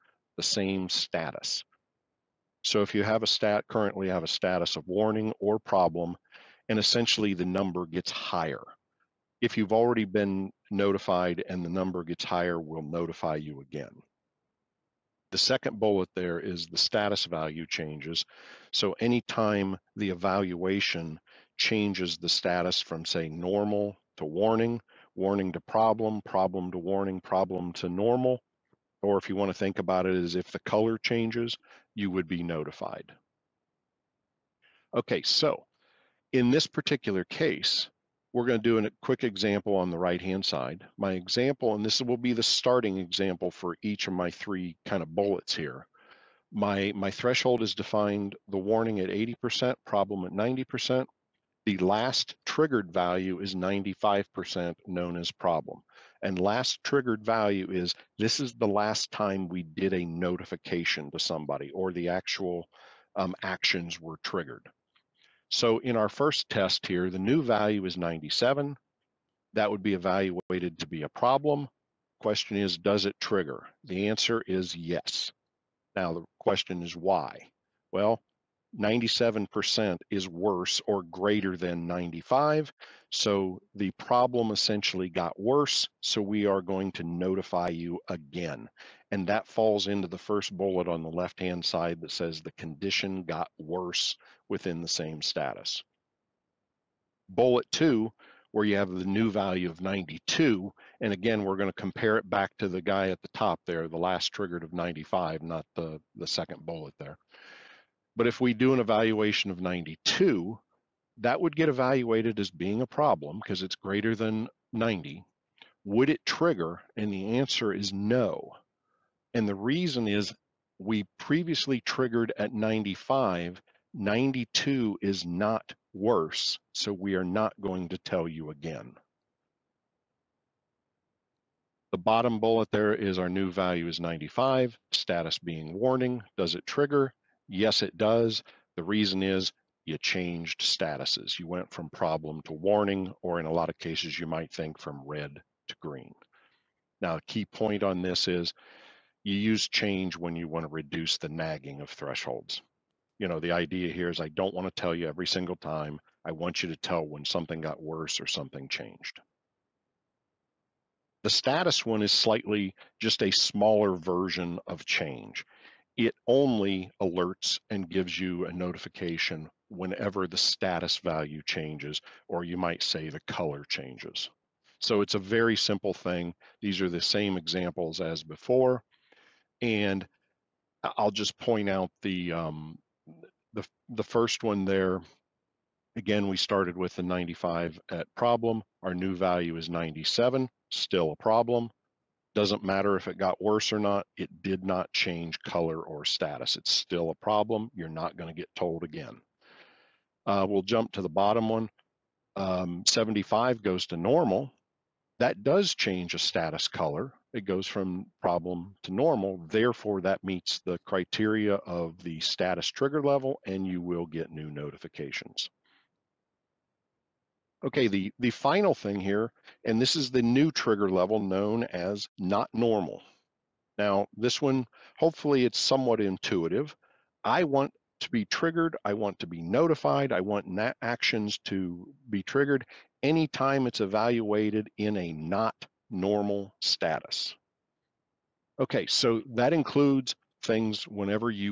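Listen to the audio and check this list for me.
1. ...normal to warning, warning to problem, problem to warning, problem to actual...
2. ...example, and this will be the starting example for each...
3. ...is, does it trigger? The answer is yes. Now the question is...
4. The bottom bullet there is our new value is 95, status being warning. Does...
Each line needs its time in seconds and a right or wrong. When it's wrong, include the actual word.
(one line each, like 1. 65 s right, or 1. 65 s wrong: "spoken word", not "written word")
1. 23 s wrong: "normal", not "actual"
2. 41 s right
3. 72 s right
4. 131 s right.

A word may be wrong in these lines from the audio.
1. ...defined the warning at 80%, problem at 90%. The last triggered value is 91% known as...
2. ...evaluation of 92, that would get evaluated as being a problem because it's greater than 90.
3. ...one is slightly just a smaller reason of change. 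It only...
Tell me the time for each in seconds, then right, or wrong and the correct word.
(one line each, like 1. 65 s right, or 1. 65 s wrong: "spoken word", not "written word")
1. 47 s wrong: "95", not "91"
2. 108 s right
3. 161 s wrong: "version", not "reason".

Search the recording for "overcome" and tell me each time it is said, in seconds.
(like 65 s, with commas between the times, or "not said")
not said.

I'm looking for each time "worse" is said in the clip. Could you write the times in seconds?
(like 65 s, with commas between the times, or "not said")
80 s, 85 s, 93 s, 125 s, 157 s, 193 s.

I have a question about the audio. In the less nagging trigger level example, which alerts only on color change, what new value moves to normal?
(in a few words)
75.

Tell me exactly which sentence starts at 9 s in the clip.
If you've already been notified and the number gets higher, we'll notify you again.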